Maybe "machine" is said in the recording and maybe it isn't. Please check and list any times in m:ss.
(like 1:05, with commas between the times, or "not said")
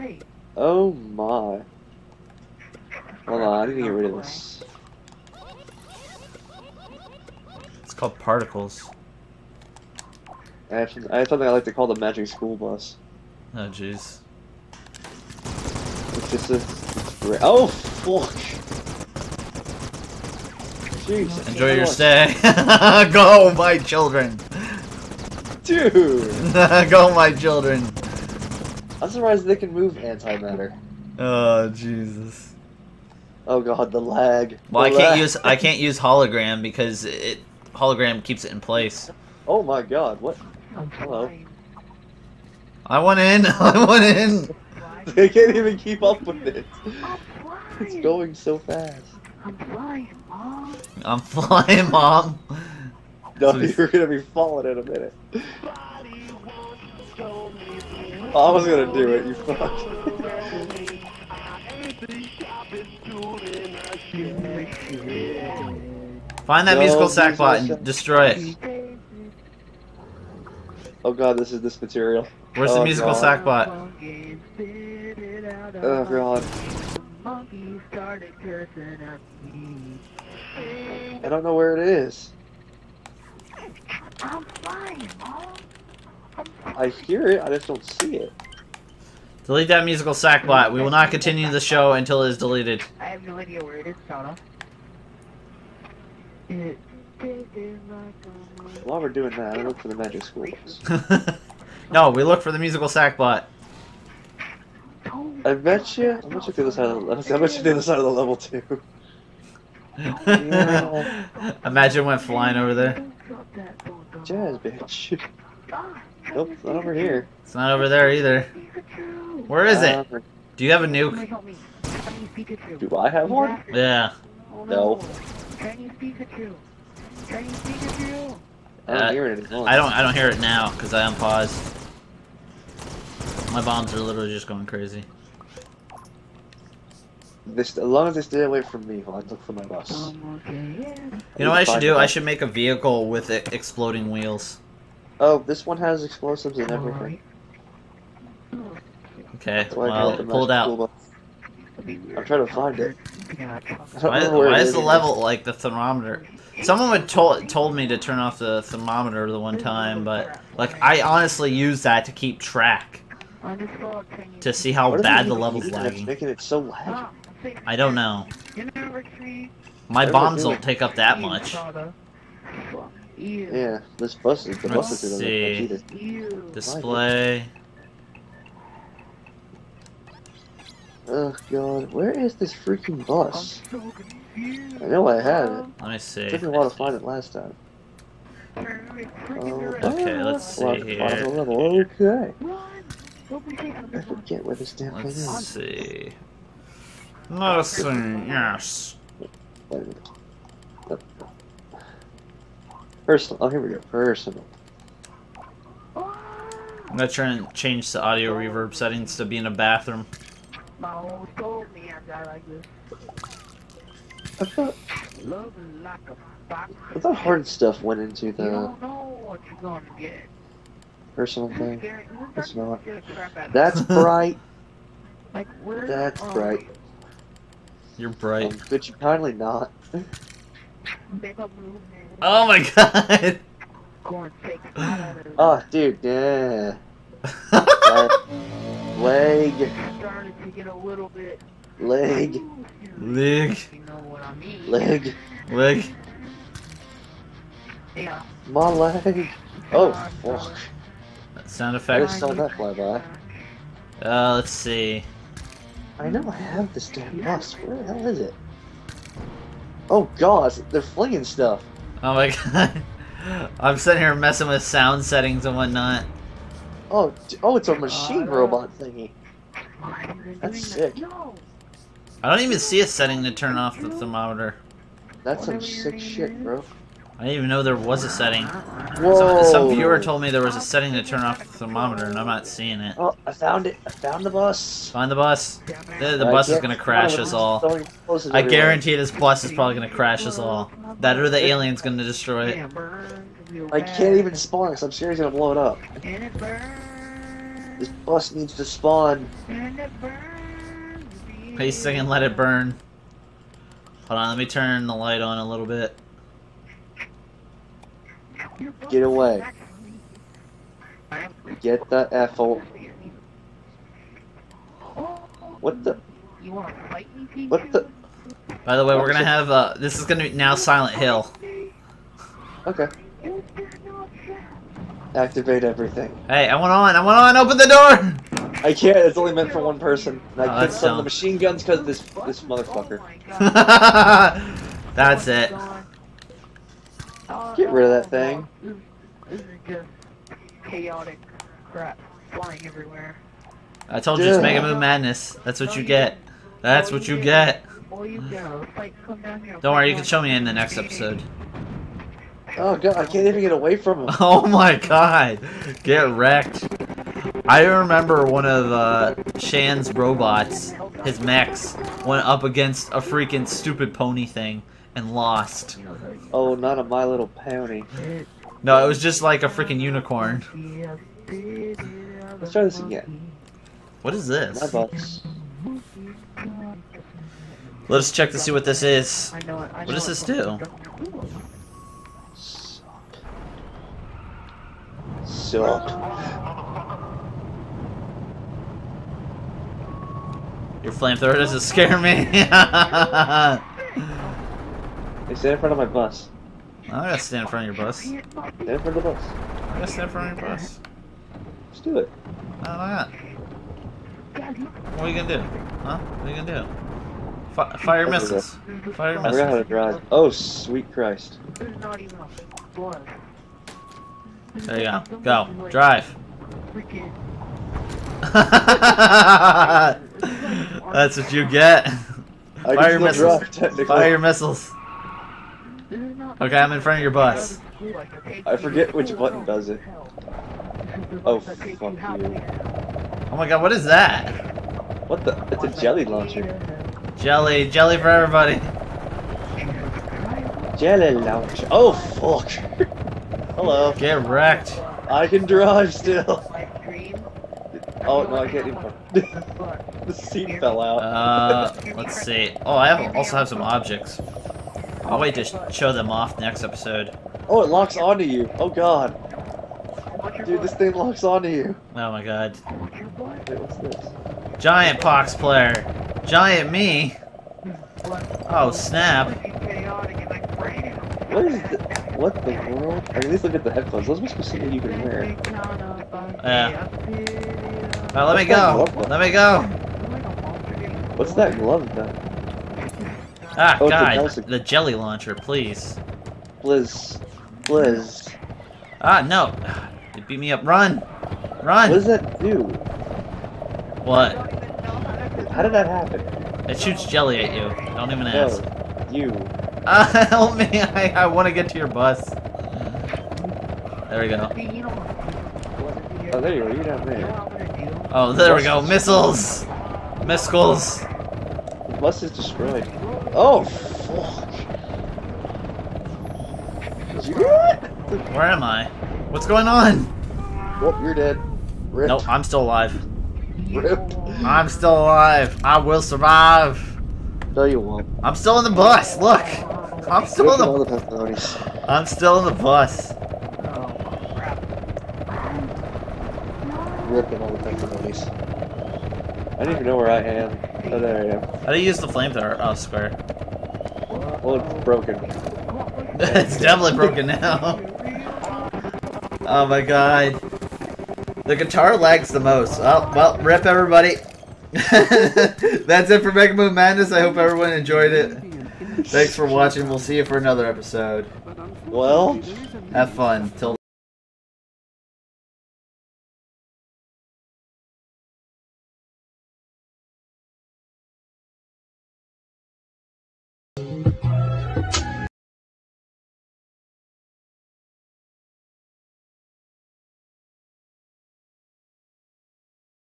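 4:27, 5:31.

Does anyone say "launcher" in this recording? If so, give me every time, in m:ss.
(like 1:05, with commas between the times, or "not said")
7:16, 7:21, 8:04.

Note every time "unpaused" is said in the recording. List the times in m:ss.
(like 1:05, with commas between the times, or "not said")
2:11.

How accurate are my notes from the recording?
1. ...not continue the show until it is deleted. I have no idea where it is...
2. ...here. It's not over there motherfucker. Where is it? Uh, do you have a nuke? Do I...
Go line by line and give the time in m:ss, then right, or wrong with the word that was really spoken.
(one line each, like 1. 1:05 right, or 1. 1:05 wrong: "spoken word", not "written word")
1. 1:30 right
2. 1:56 wrong: "either", not "motherfucker".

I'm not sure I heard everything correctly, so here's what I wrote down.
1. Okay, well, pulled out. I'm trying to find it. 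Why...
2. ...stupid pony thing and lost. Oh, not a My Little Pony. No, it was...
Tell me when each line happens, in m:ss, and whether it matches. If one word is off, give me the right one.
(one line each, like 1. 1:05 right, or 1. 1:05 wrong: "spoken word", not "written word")
1. 2:29 right
2. 6:03 right.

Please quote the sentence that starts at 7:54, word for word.
Those be specific you can wear.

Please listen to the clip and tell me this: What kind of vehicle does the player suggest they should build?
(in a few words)
Vehicle with exploding wheels.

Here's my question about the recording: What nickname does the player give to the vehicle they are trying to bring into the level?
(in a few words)
The magic school bus.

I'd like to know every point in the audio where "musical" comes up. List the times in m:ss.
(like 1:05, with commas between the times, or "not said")
1:06, 1:12, 1:29, 1:42.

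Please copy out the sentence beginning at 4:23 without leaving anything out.
I'm sitting here messing with sound settings and whatnot.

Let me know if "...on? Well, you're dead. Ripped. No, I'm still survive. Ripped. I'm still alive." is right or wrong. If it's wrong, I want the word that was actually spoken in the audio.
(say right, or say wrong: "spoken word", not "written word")
wrong: "alive", not "survive".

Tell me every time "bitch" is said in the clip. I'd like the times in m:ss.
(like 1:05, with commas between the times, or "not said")
1:54.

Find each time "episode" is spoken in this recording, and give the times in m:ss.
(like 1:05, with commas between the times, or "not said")
5:50, 7:36, 9:20.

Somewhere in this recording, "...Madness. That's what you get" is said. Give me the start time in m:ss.
5:44.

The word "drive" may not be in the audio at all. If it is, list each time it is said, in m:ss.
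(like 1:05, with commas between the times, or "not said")
6:49, 6:55, 7:25.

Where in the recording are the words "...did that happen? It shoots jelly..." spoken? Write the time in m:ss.
8:15.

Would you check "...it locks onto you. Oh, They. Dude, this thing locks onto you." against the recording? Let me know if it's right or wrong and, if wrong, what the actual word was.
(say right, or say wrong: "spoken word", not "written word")
wrong: "God", not "They".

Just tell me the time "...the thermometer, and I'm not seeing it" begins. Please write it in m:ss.
4:41.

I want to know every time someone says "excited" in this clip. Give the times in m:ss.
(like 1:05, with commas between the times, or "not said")
not said.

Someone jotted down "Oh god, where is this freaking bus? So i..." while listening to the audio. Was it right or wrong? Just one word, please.
right.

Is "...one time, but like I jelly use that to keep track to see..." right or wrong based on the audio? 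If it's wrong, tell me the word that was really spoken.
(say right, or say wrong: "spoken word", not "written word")
wrong: "honestly", not "jelly".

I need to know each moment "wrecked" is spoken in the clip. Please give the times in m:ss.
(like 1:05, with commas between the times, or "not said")
5:56, 7:24.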